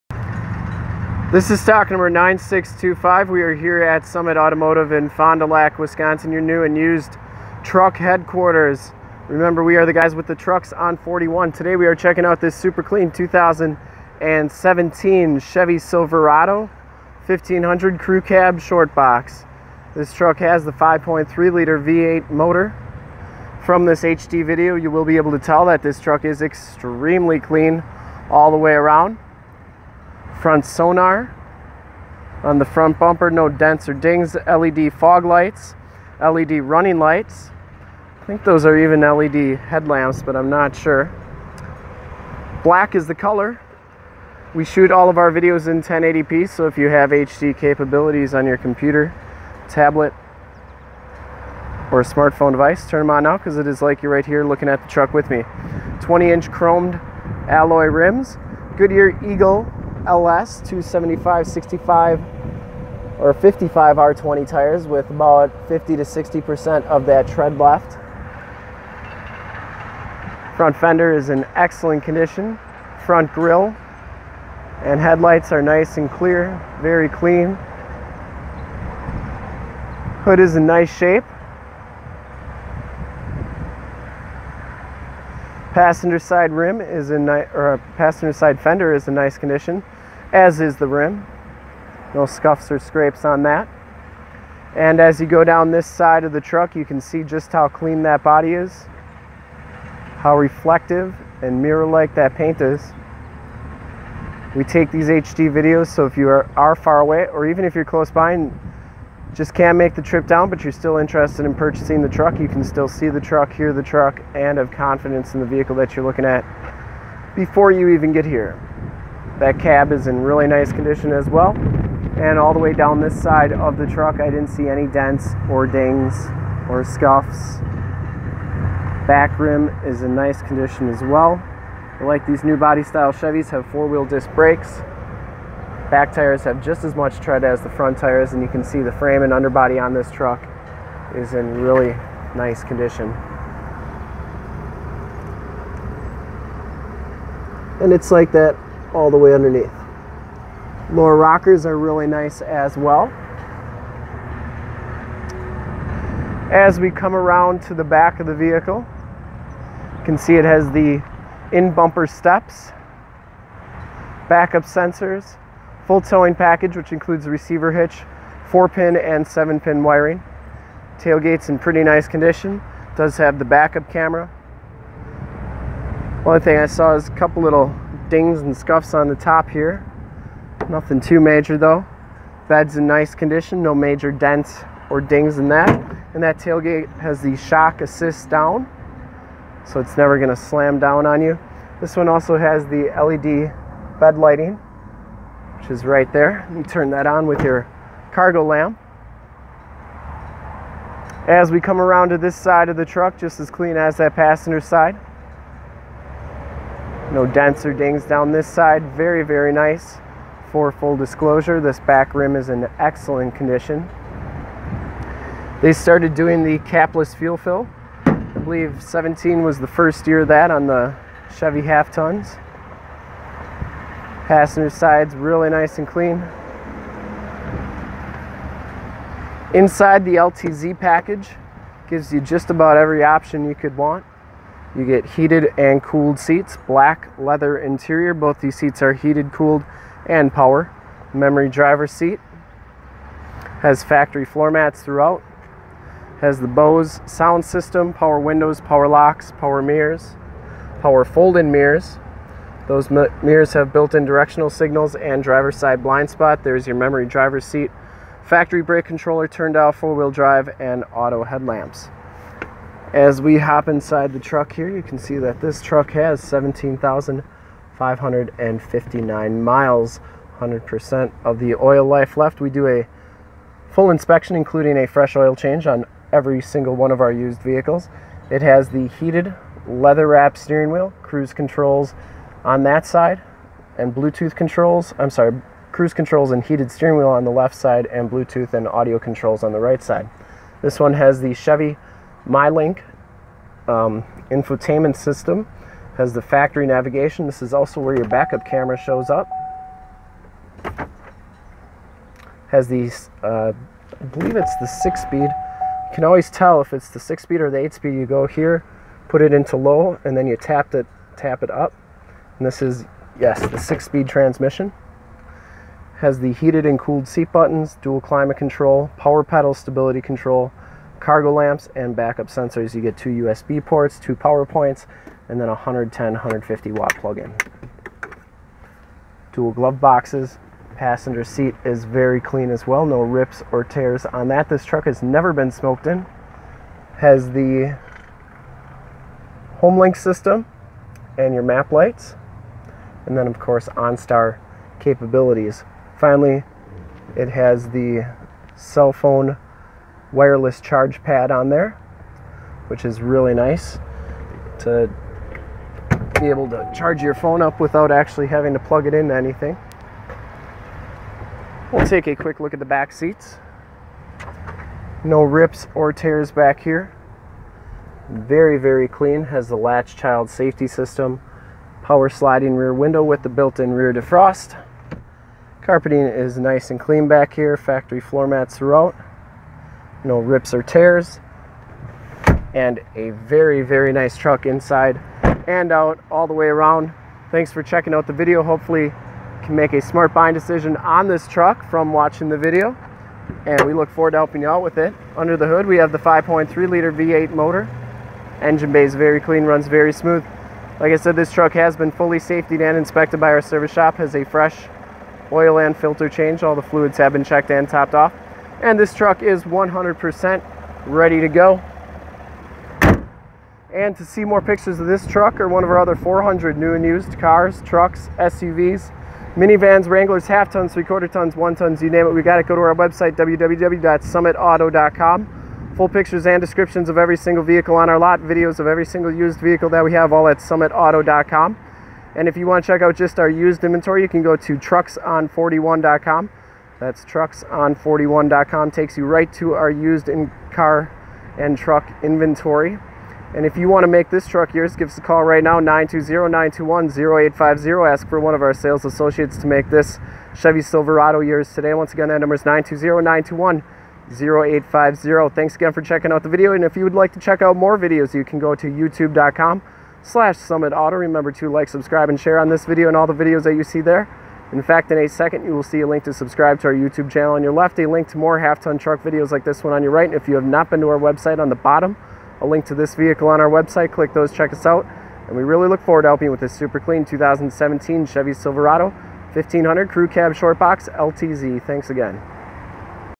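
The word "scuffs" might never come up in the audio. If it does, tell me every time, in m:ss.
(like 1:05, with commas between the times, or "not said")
1:32, 2:06, 2:58.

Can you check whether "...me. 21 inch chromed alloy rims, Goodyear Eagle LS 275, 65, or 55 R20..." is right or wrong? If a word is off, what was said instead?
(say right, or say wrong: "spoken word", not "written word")
wrong: "20", not "21".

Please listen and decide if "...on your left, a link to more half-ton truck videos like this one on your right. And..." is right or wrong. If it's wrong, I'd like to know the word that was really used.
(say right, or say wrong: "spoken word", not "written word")
right.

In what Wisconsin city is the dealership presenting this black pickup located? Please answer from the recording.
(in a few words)
Fond du Lac.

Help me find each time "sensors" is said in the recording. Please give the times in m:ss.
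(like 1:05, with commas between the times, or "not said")
2:44, 5:22.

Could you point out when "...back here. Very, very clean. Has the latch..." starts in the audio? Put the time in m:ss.
6:06.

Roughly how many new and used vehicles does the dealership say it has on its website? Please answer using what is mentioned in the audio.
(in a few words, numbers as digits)
400.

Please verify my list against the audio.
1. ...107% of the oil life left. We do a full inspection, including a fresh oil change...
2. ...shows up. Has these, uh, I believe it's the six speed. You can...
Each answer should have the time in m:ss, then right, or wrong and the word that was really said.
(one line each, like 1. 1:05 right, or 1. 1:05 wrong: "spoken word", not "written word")
1. 4:30 wrong: "100", not "107"
2. 4:58 right.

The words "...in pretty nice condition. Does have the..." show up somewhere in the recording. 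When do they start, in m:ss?
2:51.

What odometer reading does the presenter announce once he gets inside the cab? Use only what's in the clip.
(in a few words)
17,559 miles.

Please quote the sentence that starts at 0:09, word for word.
Remember, we are the guys with the trucks on 41.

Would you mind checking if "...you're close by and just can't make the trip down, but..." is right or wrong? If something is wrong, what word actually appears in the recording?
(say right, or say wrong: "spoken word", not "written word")
right.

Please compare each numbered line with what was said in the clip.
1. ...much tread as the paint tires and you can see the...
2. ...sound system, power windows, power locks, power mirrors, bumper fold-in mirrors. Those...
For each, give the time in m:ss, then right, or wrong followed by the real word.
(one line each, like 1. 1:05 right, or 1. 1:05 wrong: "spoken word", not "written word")
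1. 2:16 wrong: "front", not "paint"
2. 4:07 wrong: "power", not "bumper".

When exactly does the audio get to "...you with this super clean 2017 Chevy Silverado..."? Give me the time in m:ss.
7:56.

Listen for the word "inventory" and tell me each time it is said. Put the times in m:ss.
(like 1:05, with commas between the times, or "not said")
7:13, 7:22.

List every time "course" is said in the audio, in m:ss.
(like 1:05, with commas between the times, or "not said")
5:43.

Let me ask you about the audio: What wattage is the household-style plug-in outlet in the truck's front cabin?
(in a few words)
150 watt.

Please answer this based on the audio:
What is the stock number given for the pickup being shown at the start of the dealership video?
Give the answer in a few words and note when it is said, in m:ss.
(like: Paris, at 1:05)
9625, at 0:02.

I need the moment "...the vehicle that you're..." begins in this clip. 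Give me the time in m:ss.
1:55.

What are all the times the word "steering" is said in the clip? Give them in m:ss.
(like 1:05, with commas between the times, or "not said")
4:40, 4:46.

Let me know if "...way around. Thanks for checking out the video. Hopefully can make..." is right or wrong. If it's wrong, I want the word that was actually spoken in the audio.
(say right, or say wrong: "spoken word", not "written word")
right.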